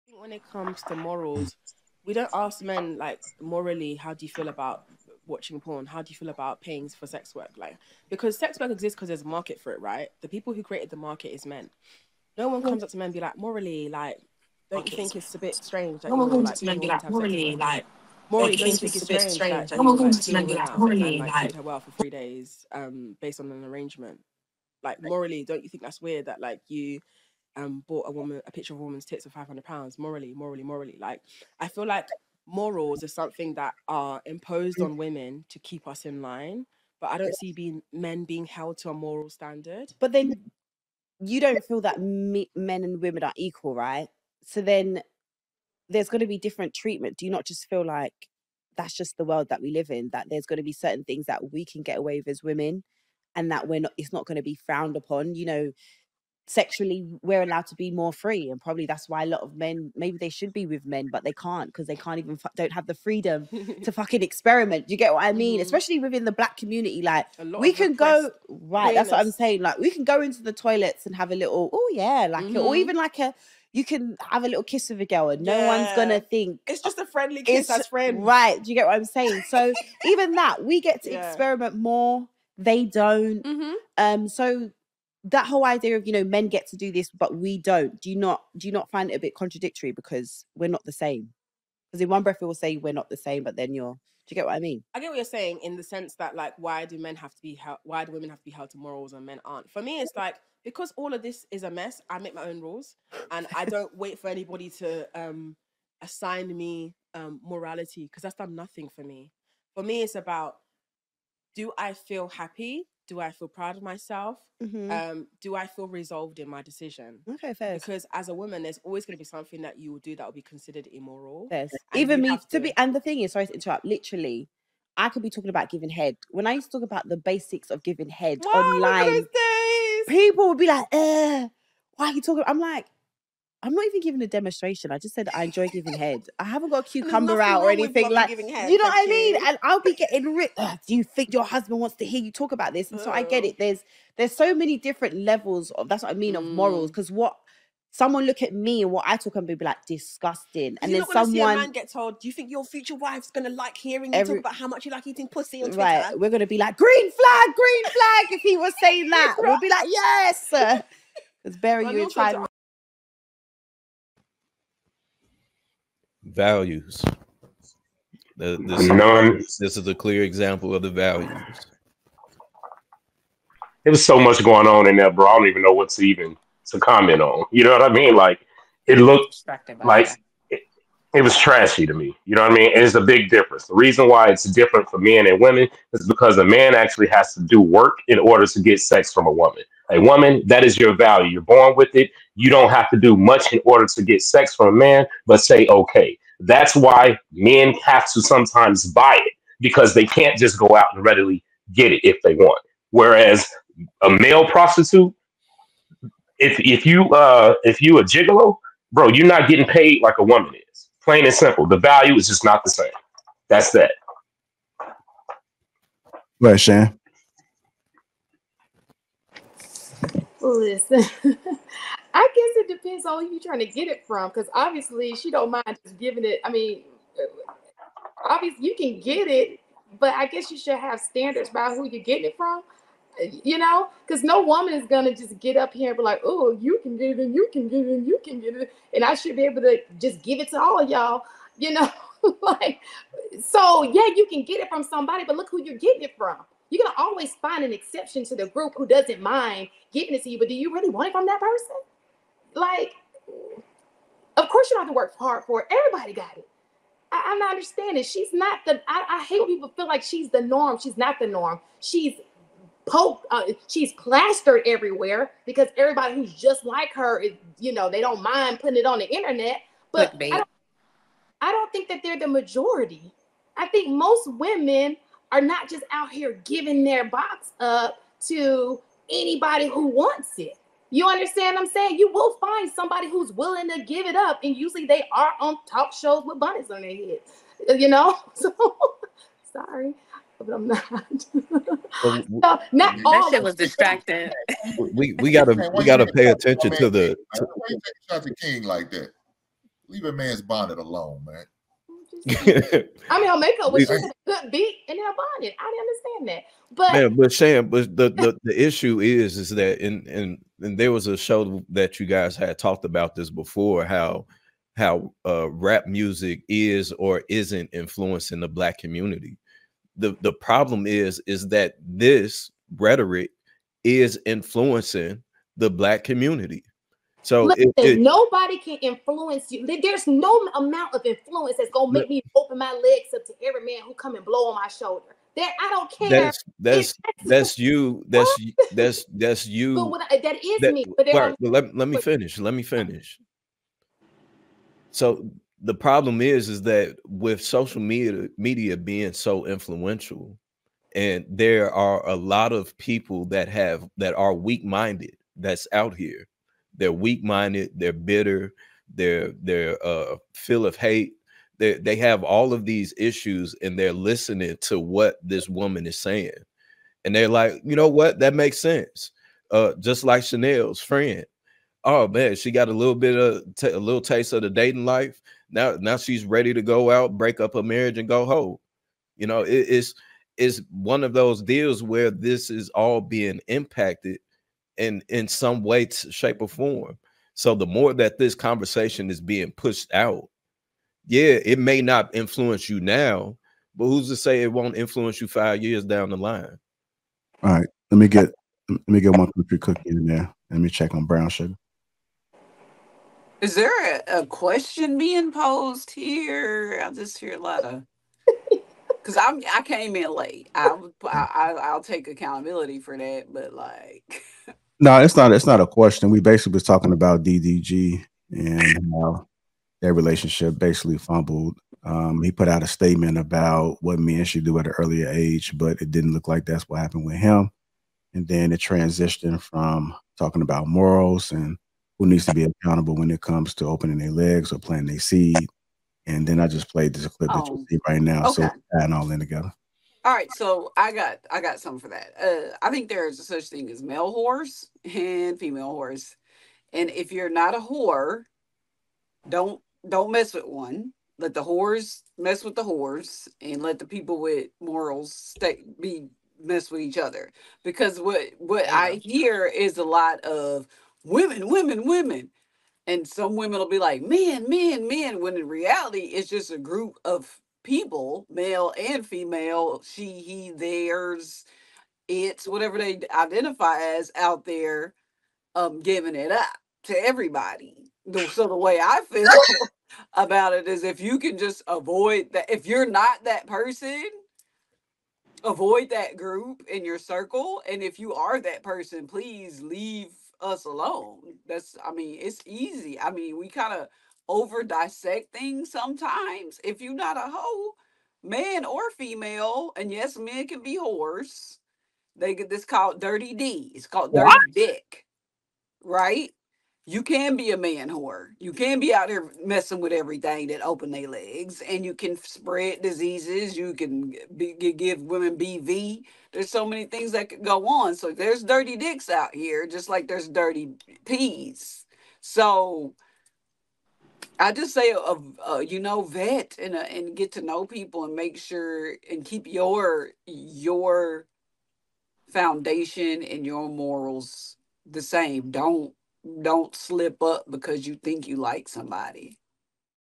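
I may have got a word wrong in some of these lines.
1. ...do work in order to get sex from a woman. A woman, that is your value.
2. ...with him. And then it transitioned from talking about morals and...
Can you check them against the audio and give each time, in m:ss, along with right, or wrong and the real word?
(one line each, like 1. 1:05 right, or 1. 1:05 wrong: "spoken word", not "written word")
1. 3:07 right
2. 7:07 right.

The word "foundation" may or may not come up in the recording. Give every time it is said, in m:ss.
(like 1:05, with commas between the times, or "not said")
8:52.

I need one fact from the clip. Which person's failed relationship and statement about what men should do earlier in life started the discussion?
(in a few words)
DDG.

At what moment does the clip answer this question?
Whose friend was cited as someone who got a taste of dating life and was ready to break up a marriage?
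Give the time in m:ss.
6:10.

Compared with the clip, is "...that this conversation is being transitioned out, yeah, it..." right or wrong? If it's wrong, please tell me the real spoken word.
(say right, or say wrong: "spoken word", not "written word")
wrong: "pushed", not "transitioned".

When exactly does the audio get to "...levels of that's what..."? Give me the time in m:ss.
2:25.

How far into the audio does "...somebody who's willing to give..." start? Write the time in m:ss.
4:42.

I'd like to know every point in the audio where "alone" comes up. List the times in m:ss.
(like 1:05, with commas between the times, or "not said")
5:00, 8:10.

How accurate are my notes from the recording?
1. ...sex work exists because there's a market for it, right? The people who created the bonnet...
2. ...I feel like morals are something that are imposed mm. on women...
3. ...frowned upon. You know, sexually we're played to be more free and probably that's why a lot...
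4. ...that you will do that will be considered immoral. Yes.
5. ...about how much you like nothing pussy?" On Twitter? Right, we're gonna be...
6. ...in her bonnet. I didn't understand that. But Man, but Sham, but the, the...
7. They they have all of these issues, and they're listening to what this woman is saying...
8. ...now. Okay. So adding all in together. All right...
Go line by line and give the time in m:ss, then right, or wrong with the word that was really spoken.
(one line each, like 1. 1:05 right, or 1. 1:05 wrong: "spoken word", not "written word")
1. 0:08 wrong: "market", not "bonnet"
2. 0:31 right
3. 0:54 wrong: "allowed", not "played"
4. 1:59 right
5. 2:34 wrong: "eating", not "nothing"
6. 5:04 right
7. 6:01 right
8. 7:18 right.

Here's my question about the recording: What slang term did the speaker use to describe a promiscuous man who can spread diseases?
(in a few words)
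dirty dick.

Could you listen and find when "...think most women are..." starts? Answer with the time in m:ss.
4:33.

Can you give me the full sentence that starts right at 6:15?
Now, now she's ready to go out, break up a marriage, and go home.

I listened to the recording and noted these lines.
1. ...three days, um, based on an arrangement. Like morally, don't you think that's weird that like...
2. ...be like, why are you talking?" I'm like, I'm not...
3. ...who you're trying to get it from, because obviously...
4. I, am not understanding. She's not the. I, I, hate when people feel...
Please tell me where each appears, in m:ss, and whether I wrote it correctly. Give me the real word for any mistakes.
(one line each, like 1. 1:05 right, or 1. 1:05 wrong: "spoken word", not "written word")
1. 0:21 right
2. 2:10 right
3. 3:43 right
4. 4:17 right.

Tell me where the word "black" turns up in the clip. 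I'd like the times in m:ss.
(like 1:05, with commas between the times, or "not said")
1:06, 5:18, 5:25.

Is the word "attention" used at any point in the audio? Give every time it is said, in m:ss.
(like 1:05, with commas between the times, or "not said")
4:56.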